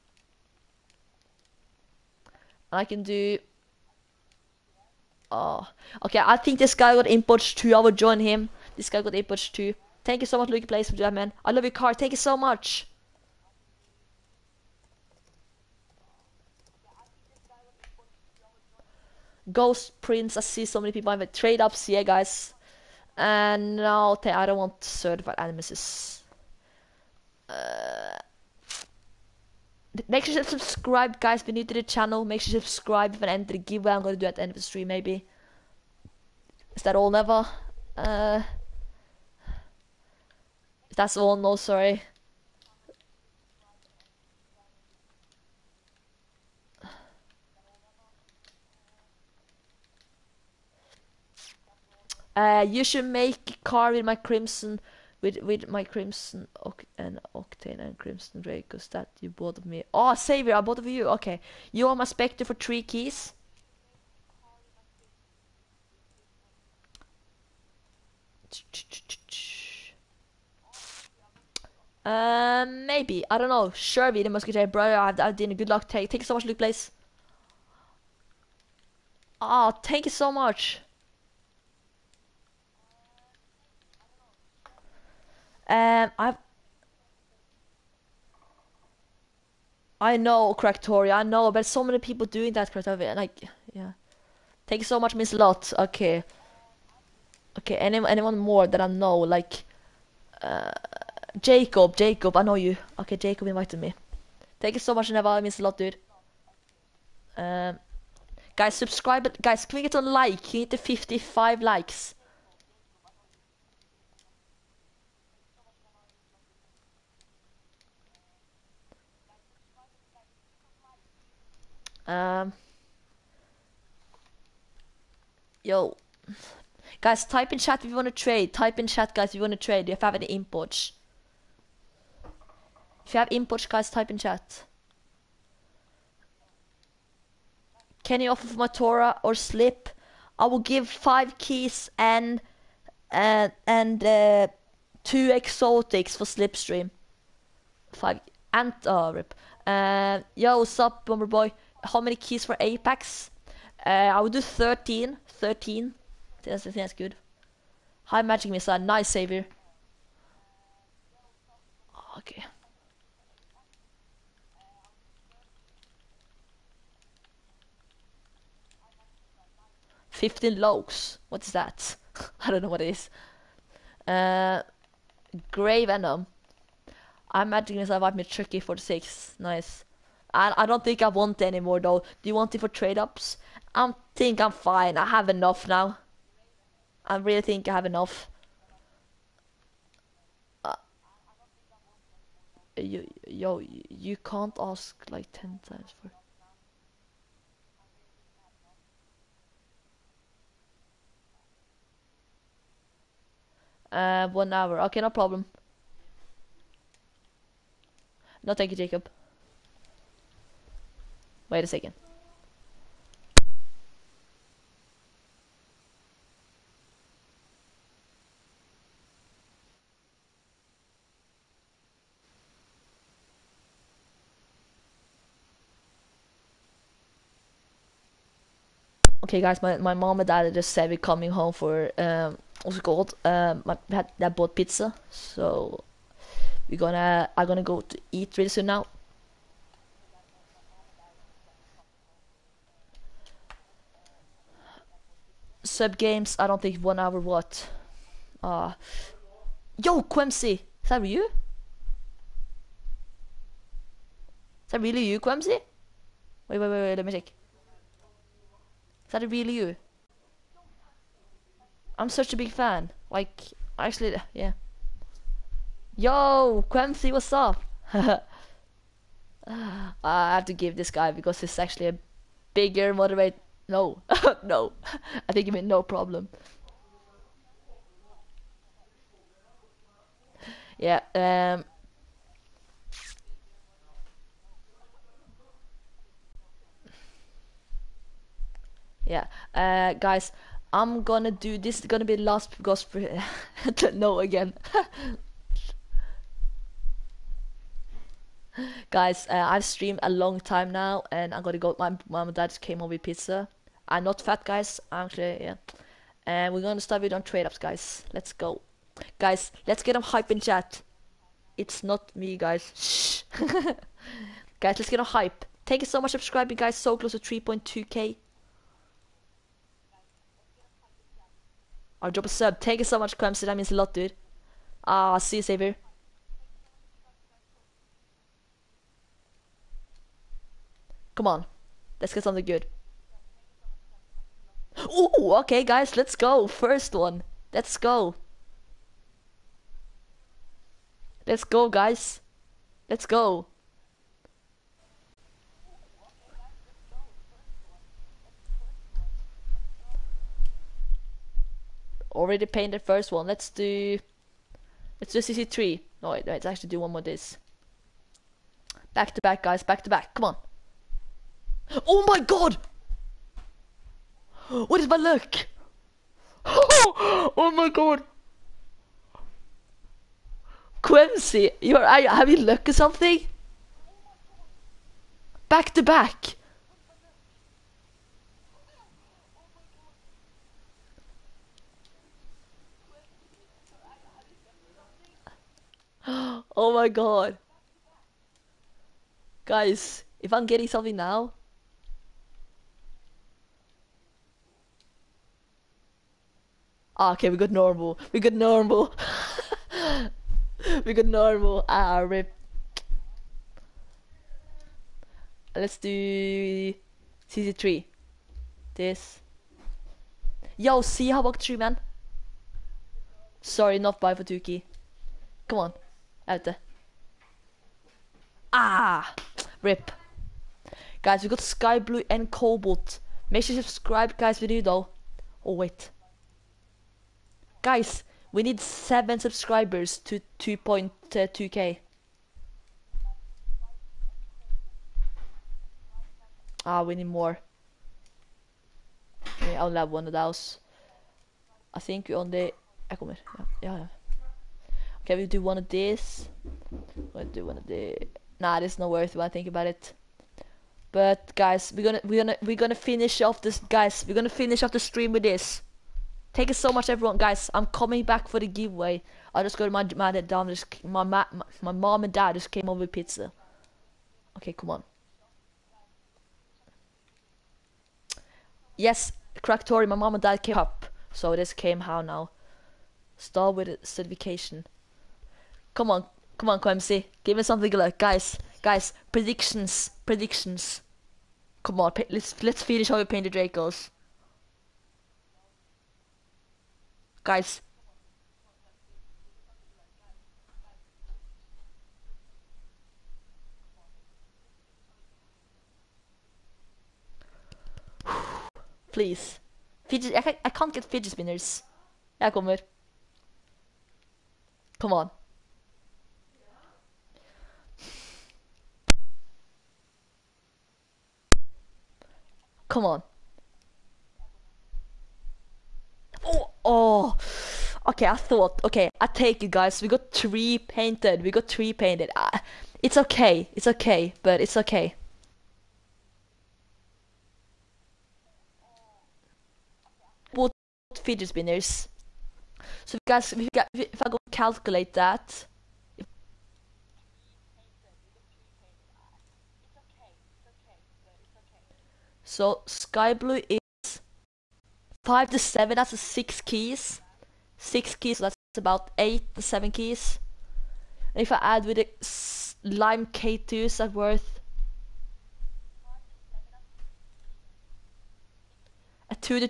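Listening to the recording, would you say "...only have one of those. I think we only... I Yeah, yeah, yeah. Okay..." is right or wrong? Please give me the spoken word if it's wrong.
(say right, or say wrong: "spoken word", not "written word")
right.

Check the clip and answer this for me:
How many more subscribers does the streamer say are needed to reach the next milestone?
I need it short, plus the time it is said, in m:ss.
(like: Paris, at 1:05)
7, at 7:08.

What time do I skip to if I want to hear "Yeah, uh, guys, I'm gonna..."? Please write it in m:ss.
4:49.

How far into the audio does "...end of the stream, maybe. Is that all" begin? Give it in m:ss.
0:34.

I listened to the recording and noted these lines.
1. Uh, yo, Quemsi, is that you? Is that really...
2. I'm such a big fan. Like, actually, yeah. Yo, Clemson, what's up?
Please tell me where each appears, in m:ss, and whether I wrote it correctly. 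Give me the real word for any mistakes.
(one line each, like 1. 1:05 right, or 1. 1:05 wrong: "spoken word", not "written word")
1. 4:08 right
2. 4:21 wrong: "Quemsi", not "Clemson".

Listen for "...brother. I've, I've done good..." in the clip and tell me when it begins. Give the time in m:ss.
1:14.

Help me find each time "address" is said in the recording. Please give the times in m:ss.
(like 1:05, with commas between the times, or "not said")
not said.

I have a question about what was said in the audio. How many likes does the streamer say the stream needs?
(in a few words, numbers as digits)
55.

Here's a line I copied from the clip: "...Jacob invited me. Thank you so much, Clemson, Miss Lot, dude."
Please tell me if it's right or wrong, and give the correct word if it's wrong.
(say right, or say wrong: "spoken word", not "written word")
wrong: "Neva", not "Clemson".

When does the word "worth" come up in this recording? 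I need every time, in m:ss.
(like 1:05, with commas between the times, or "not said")
7:28, 9:13.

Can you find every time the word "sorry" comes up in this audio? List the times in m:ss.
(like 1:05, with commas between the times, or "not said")
0:41, 6:53.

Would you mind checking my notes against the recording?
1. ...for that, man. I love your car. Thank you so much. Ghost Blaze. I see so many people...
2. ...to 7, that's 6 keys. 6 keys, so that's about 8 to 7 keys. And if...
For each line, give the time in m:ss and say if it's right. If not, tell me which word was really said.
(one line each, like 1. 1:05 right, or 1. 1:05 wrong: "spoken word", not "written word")
1. 0:10 wrong: "Prince", not "Blaze"
2. 9:05 right.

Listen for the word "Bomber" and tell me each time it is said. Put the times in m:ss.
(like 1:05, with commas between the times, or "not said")
2:31.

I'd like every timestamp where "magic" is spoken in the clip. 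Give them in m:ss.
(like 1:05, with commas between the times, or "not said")
2:38, 2:57.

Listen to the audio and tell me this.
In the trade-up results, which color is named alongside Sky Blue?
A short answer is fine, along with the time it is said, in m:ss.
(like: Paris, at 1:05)
Cobalt, at 7:02.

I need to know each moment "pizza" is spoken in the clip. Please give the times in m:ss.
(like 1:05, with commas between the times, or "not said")
3:54, 5:03, 7:42.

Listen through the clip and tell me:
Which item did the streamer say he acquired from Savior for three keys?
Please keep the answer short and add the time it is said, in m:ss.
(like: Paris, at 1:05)
Specter, at 1:01.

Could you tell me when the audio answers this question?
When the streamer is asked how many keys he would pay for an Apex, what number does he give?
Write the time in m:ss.
2:33.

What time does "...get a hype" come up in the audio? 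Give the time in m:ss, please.
5:14.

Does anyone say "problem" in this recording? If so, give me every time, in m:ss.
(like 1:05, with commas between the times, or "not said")
3:25, 4:35.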